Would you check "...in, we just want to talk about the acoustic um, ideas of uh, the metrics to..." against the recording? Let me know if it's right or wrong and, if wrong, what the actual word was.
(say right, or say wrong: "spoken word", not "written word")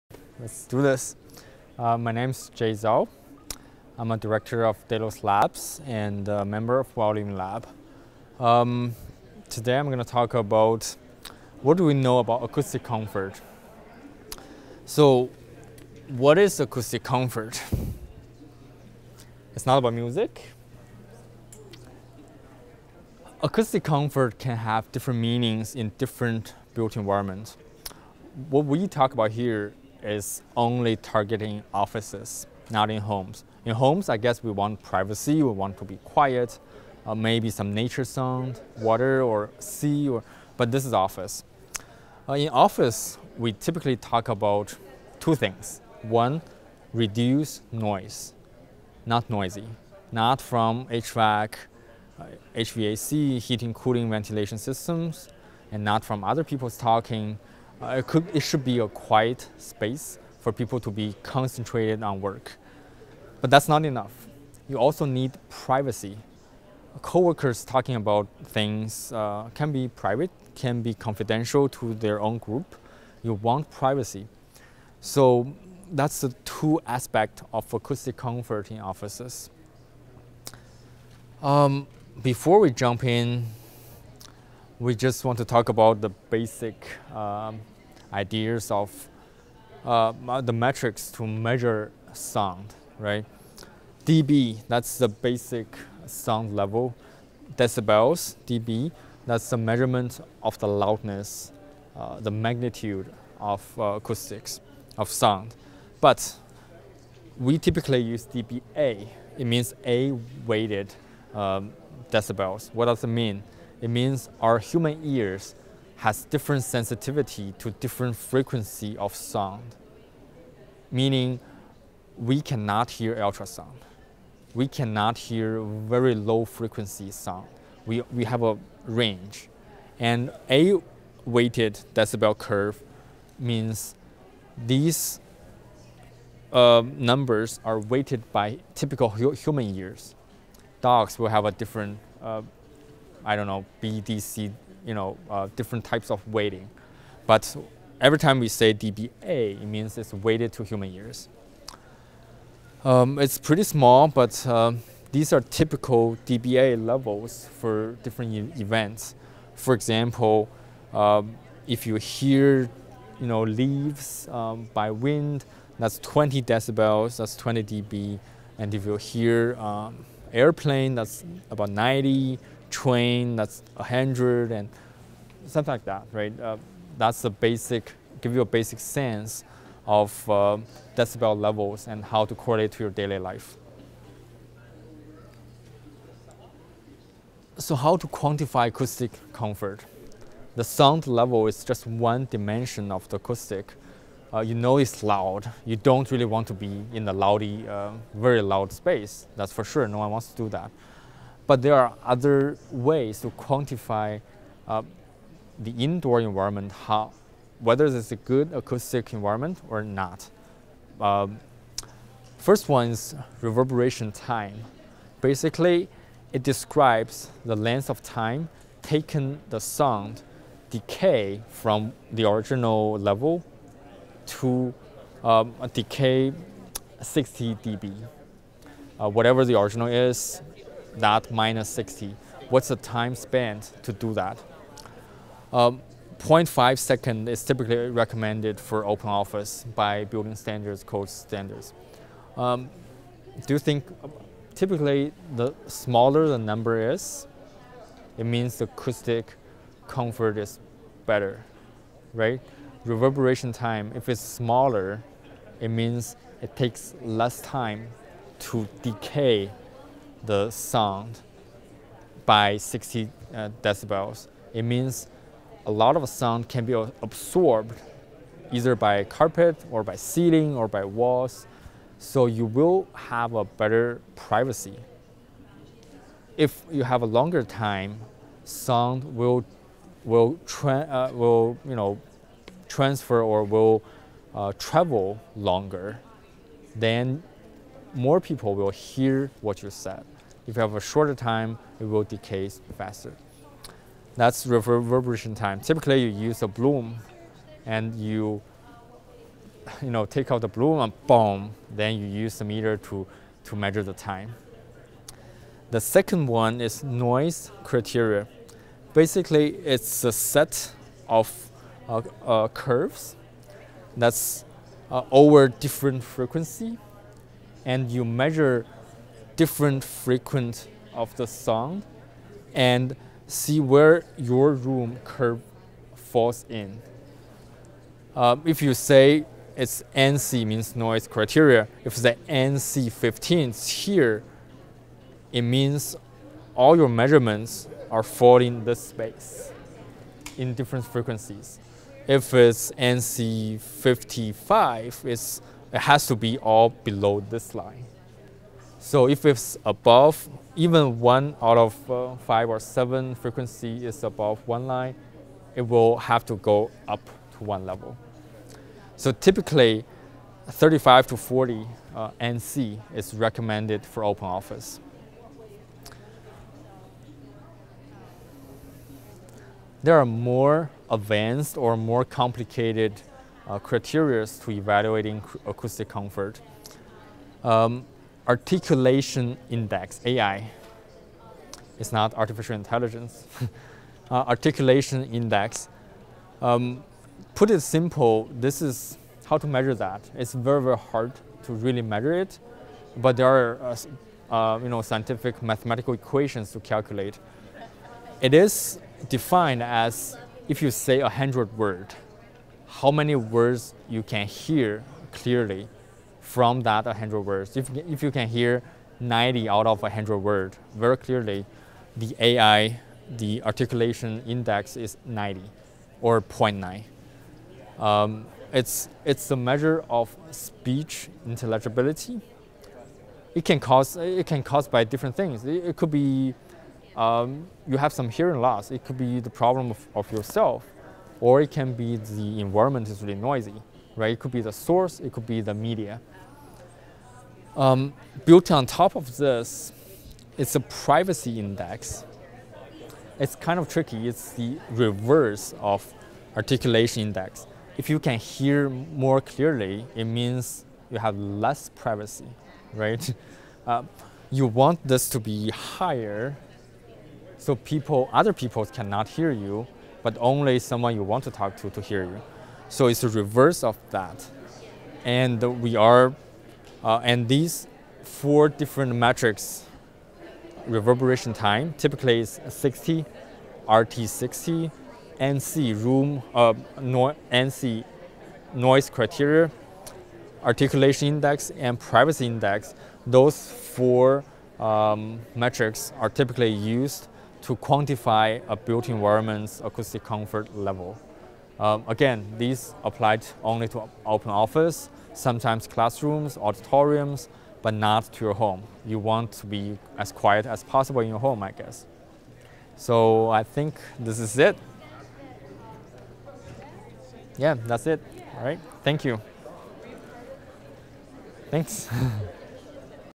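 wrong: "basic", not "acoustic".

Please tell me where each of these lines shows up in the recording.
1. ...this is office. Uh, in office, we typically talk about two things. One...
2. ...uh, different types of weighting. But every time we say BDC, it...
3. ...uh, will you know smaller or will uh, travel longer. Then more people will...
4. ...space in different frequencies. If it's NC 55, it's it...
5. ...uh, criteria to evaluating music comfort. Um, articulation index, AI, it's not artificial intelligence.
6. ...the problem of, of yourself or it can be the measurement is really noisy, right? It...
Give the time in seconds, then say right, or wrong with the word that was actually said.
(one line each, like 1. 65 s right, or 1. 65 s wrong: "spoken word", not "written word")
1. 40 s right
2. 145 s wrong: "DBA", not "BDC"
3. 280 s wrong: "transfer", not "smaller"
4. 338 s right
5. 373 s wrong: "acoustic", not "music"
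6. 429 s wrong: "environment", not "measurement".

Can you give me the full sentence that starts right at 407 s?
If, if you can hear 90 out of 100 words very clearly, the AI, the articulation index is 90 or 0.9.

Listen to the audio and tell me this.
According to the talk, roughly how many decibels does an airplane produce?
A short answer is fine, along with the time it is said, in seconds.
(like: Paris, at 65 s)
90, at 171 s.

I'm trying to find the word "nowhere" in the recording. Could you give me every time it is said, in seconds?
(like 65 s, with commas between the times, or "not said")
not said.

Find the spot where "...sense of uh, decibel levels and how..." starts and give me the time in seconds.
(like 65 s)
178 s.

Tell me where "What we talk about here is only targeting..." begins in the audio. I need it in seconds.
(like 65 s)
28 s.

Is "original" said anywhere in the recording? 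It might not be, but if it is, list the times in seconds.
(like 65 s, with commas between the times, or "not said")
222 s, 229 s.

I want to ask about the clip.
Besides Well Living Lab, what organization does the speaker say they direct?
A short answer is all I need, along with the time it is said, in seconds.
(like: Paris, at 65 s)
Delos Labs, at 4 s.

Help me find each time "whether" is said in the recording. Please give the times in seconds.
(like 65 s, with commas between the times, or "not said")
207 s.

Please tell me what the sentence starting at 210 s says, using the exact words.
Um, first one is reverberation time.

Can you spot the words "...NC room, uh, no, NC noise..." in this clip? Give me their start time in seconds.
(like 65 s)
475 s.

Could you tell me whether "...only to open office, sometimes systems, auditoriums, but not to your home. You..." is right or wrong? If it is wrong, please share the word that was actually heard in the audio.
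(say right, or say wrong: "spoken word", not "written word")
wrong: "classrooms", not "systems".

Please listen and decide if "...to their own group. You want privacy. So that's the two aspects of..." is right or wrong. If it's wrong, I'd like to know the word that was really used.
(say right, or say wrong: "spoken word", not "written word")
right.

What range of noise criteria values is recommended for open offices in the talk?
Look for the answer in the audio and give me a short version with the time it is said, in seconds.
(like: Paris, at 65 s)
35 to 40, at 360 s.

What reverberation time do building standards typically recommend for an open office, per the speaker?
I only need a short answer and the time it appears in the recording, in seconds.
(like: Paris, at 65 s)
0.5 second, at 236 s.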